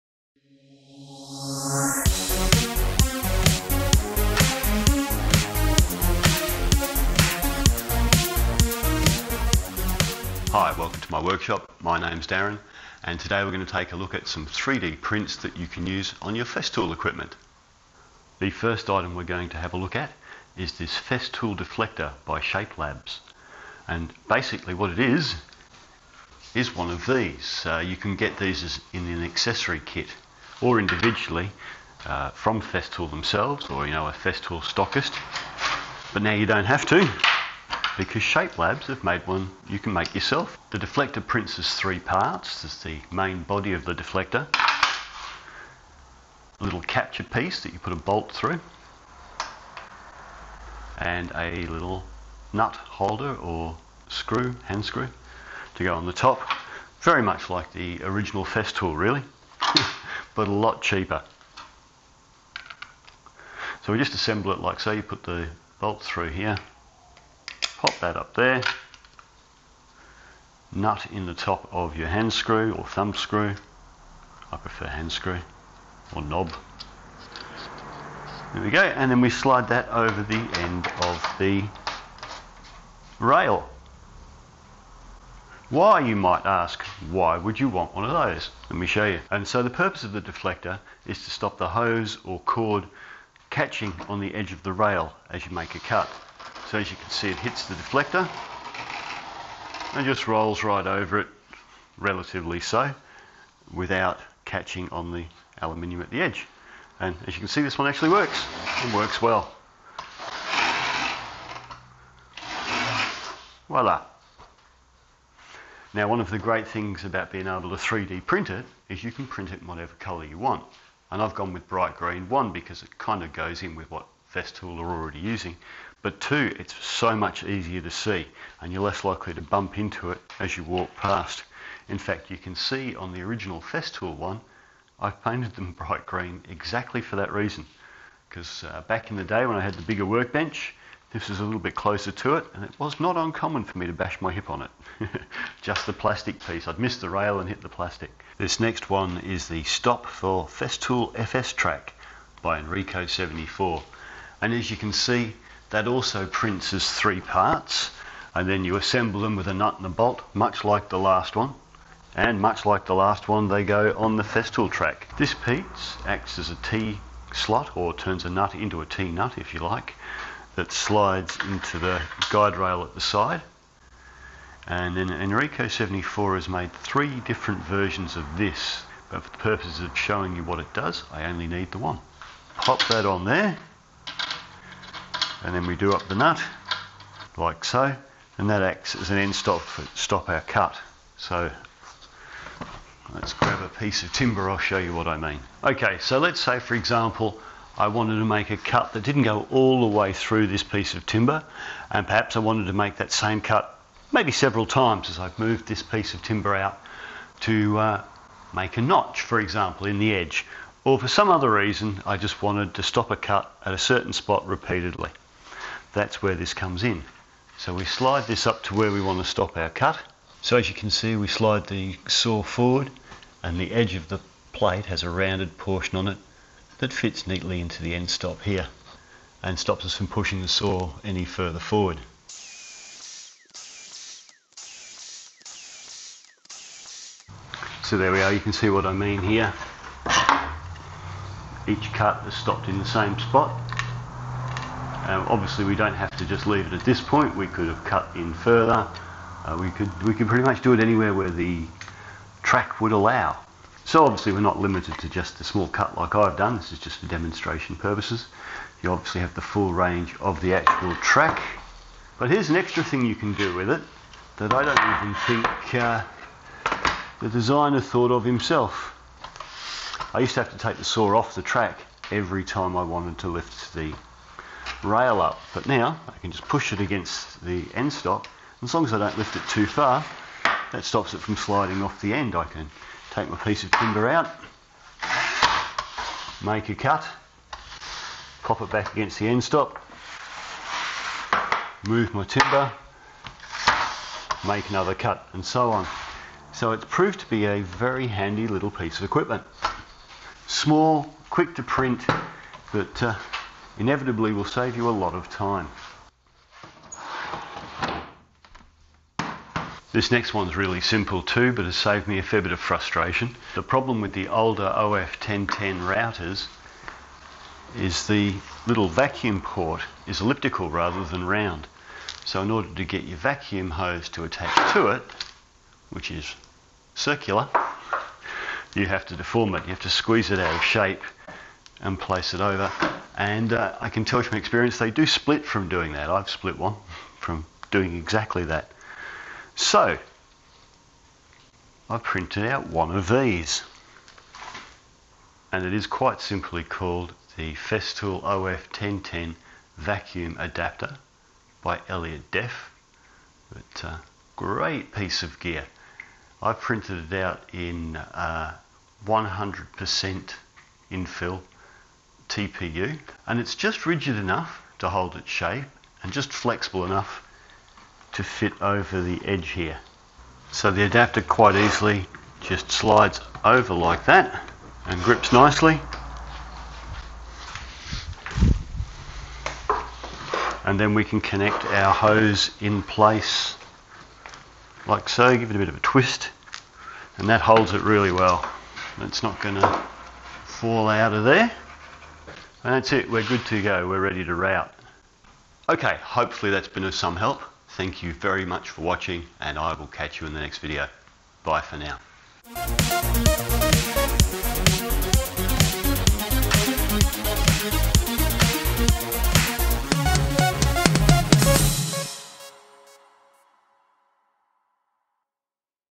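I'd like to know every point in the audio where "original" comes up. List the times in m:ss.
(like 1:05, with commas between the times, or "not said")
0:58, 2:13.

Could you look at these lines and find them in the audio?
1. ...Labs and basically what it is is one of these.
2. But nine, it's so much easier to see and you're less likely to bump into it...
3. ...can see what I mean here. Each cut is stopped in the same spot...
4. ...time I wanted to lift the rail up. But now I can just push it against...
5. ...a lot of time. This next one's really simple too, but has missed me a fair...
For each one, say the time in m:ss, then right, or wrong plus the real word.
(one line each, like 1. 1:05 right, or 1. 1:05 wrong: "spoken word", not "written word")
1. 0:22 right
2. 2:06 wrong: "two", not "nine"
3. 3:58 right
4. 4:32 right
5. 5:04 wrong: "saved", not "missed".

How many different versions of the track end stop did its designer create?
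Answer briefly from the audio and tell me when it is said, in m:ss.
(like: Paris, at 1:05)
3, at 2:56.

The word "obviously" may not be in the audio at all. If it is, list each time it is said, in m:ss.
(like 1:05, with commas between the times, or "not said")
4:05, 4:14, 4:18.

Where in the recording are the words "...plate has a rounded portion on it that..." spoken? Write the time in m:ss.
3:44.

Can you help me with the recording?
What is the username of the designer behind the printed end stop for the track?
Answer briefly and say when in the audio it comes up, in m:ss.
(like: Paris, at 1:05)
Enrico74, at 2:32.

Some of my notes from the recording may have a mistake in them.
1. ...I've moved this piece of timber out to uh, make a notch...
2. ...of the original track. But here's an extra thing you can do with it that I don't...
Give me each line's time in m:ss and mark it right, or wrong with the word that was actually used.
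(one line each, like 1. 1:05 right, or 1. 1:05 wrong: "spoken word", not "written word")
1. 3:25 right
2. 4:20 wrong: "actual", not "original".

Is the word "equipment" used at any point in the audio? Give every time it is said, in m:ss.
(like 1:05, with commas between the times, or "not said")
0:16, 4:59.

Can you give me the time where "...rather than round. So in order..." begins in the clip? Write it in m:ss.
5:20.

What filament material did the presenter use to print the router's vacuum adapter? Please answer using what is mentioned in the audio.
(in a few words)
TPU.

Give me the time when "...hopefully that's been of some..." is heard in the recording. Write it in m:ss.
6:36.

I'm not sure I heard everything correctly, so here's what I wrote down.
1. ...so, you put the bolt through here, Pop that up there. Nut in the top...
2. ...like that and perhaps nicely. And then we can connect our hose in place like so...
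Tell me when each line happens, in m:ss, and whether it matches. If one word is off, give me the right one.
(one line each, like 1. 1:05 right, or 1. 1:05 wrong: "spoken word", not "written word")
1. 1:04 right
2. 6:13 wrong: "grips", not "perhaps".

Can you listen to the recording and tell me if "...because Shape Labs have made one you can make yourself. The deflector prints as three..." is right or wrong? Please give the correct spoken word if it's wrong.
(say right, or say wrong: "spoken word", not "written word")
right.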